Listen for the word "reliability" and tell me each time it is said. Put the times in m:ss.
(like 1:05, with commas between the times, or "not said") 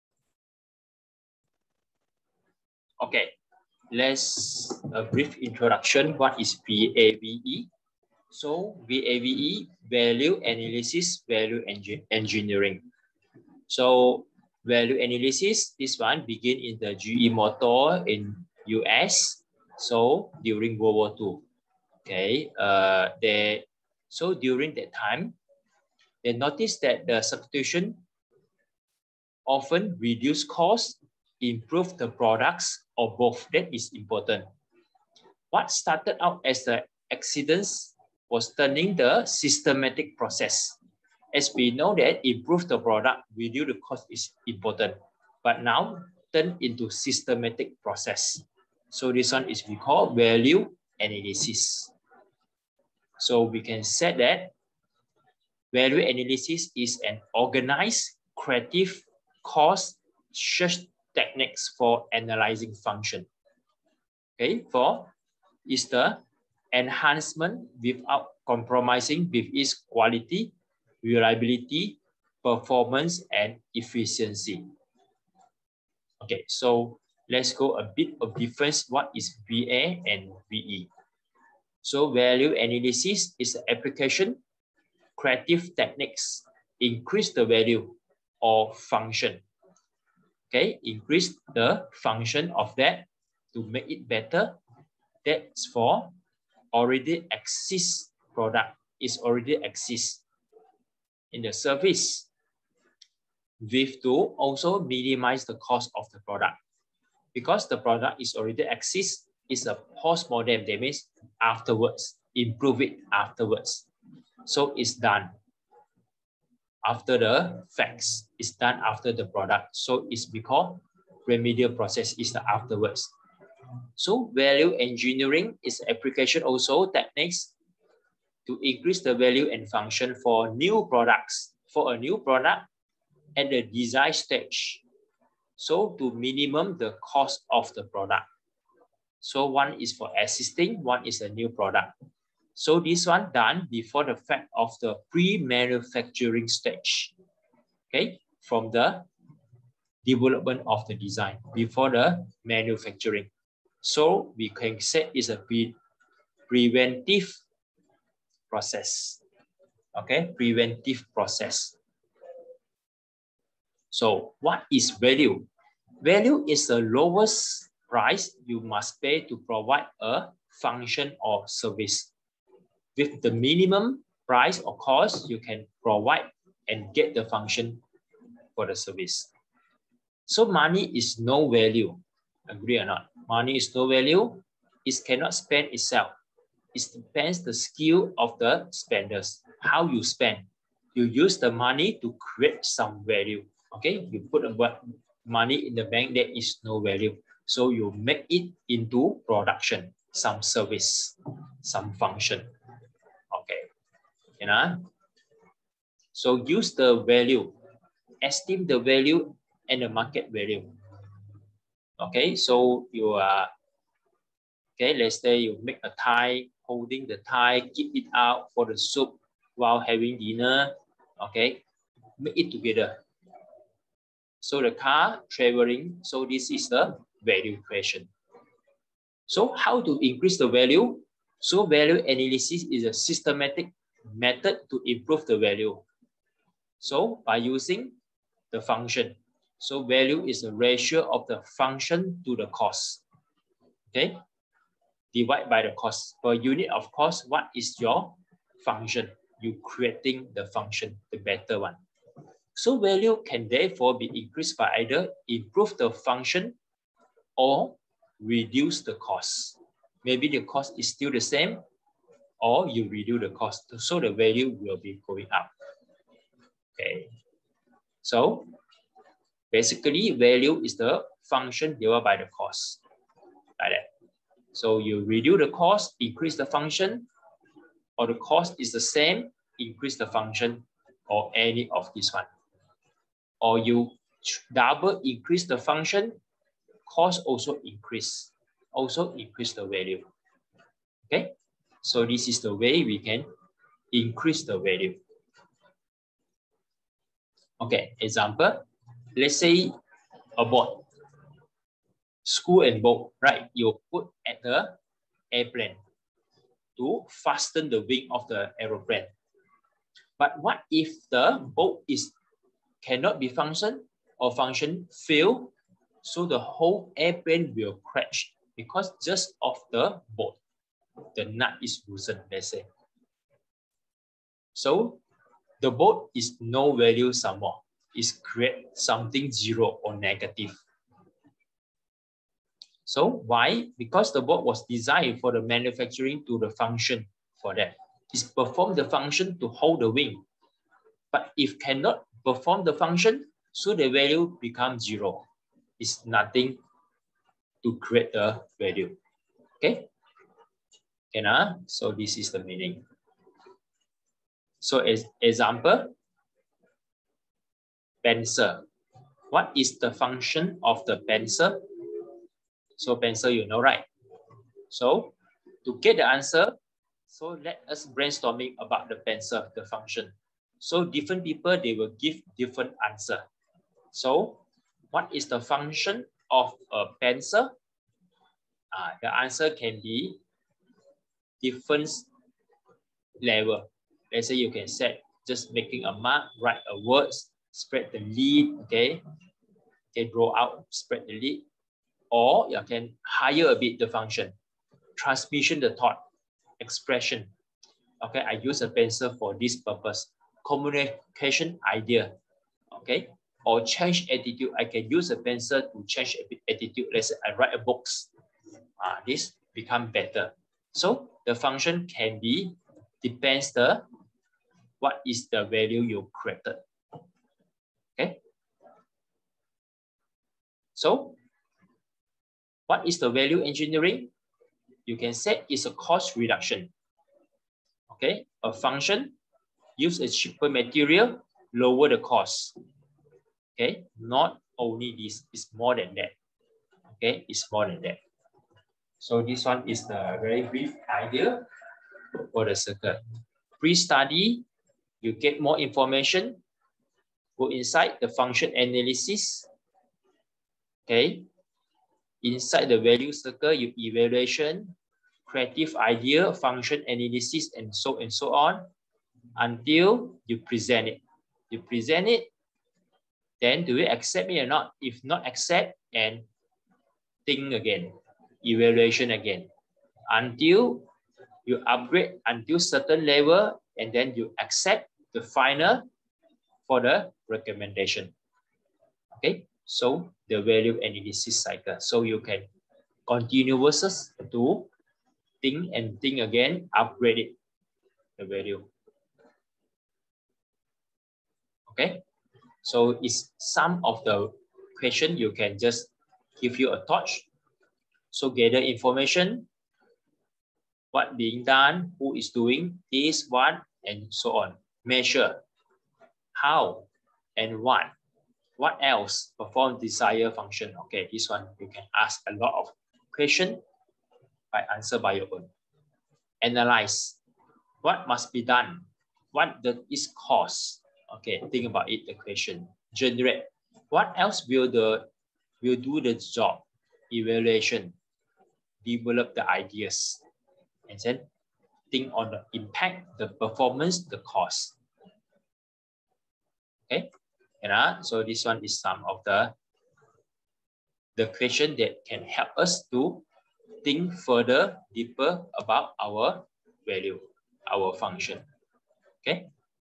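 1:11.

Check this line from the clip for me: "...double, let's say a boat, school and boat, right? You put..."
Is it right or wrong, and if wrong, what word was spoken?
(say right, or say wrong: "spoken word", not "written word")
wrong: "example", not "double".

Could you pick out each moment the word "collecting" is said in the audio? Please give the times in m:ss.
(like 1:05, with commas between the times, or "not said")
not said.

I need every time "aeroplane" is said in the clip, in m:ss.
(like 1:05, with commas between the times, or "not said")
5:08.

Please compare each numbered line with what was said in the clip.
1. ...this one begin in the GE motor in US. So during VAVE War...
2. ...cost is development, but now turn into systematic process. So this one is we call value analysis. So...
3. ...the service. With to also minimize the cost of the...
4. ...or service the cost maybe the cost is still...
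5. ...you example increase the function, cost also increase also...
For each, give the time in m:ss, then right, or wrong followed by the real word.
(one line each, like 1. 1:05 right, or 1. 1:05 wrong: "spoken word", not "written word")
1. 0:15 wrong: "World", not "VAVE"
2. 0:43 wrong: "important", not "development"
3. 1:41 right
4. 4:17 wrong: "reduce", not "service"
5. 4:43 wrong: "double", not "example".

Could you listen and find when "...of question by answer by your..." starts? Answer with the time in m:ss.
8:32.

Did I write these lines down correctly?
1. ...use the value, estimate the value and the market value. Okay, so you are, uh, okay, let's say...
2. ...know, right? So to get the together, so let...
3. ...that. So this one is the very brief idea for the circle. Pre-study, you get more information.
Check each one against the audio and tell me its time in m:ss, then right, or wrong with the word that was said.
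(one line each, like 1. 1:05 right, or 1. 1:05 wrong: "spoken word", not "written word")
1. 3:26 right
2. 6:03 wrong: "answer", not "together"
3. 7:17 right.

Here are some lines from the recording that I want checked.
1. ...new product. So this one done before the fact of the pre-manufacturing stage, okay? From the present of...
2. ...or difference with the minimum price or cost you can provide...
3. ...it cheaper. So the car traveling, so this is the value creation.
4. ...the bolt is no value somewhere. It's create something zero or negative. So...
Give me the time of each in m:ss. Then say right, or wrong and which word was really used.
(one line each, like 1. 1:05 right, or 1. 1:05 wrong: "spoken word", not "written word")
1. 2:21 wrong: "development", not "present"
2. 2:51 wrong: "service", not "difference"
3. 3:42 wrong: "together", not "cheaper"
4. 5:25 right.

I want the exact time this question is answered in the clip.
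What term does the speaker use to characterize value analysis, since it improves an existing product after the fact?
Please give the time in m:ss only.
2:01.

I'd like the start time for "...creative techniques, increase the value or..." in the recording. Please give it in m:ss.
1:25.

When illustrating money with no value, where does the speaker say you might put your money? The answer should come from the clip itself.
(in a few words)
in the bank.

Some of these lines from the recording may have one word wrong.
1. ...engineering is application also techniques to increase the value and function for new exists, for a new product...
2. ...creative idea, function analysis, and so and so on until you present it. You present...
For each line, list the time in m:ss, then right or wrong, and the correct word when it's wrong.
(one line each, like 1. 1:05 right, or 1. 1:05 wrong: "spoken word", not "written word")
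1. 2:04 wrong: "products", not "exists"
2. 7:35 right.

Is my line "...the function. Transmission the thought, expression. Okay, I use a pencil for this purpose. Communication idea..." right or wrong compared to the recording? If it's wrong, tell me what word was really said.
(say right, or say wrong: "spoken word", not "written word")
right.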